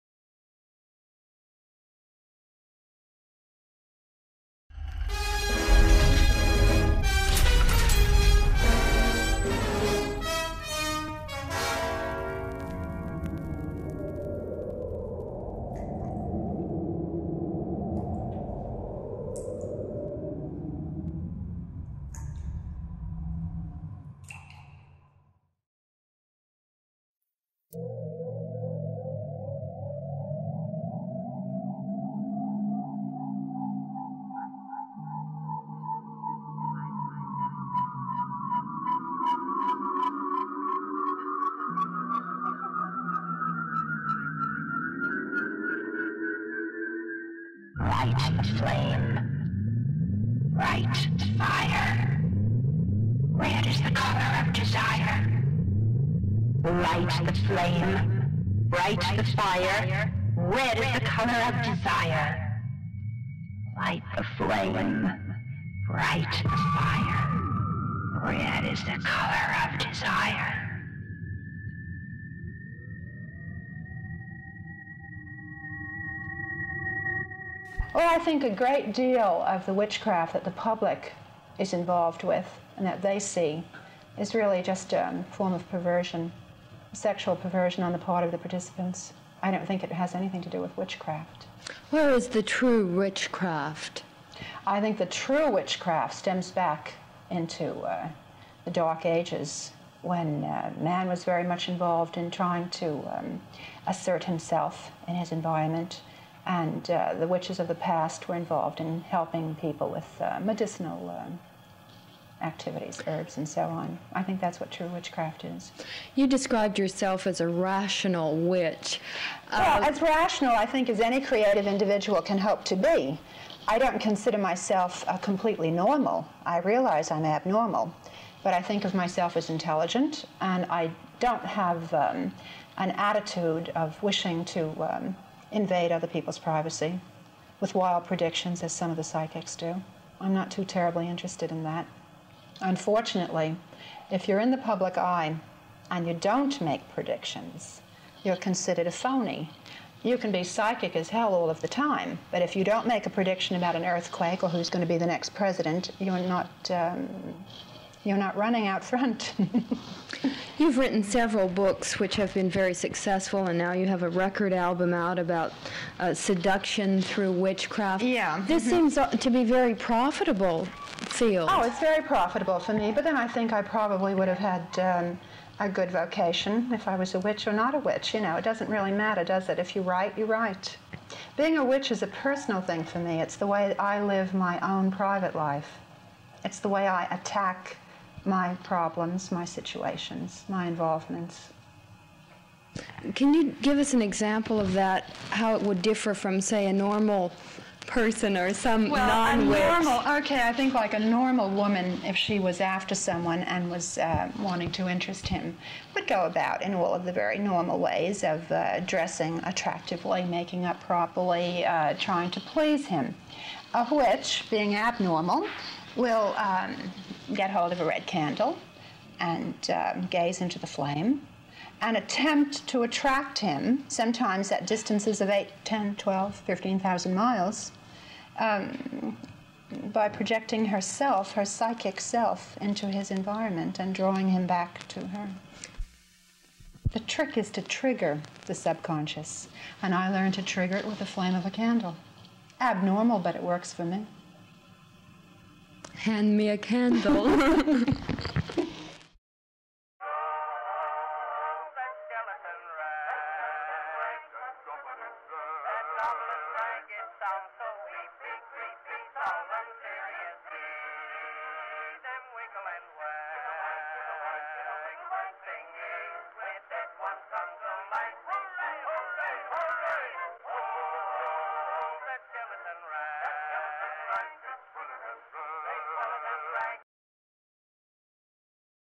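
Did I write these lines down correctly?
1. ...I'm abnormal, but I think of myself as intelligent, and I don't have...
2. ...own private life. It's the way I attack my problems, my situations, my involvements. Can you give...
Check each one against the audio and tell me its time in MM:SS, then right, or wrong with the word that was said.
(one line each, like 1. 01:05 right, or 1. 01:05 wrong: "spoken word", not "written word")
1. 02:07 right
2. 03:04 right.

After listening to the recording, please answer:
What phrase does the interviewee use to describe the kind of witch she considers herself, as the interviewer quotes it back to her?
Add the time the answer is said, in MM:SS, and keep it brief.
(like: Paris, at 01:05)
Rational witch, at 01:57.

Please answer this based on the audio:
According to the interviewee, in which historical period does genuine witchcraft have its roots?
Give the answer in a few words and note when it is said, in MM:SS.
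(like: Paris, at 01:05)
The Dark Ages, at 01:38.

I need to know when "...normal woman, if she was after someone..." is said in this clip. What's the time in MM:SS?
03:20.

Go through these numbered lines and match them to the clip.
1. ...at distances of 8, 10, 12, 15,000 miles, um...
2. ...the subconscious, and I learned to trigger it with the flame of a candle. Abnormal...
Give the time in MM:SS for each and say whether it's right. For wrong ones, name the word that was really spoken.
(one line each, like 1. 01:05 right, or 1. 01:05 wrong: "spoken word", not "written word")
1. 03:44 right
2. 03:58 right.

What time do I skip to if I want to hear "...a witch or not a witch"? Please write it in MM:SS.
02:57.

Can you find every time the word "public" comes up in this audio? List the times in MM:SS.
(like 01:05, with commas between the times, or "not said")
01:20, 02:24.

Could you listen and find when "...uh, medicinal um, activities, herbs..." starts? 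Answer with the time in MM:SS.
01:50.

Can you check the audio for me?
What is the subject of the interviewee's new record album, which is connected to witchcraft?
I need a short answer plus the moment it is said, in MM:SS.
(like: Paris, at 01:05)
Seduction, at 02:46.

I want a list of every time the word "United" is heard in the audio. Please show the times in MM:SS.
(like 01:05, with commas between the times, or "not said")
not said.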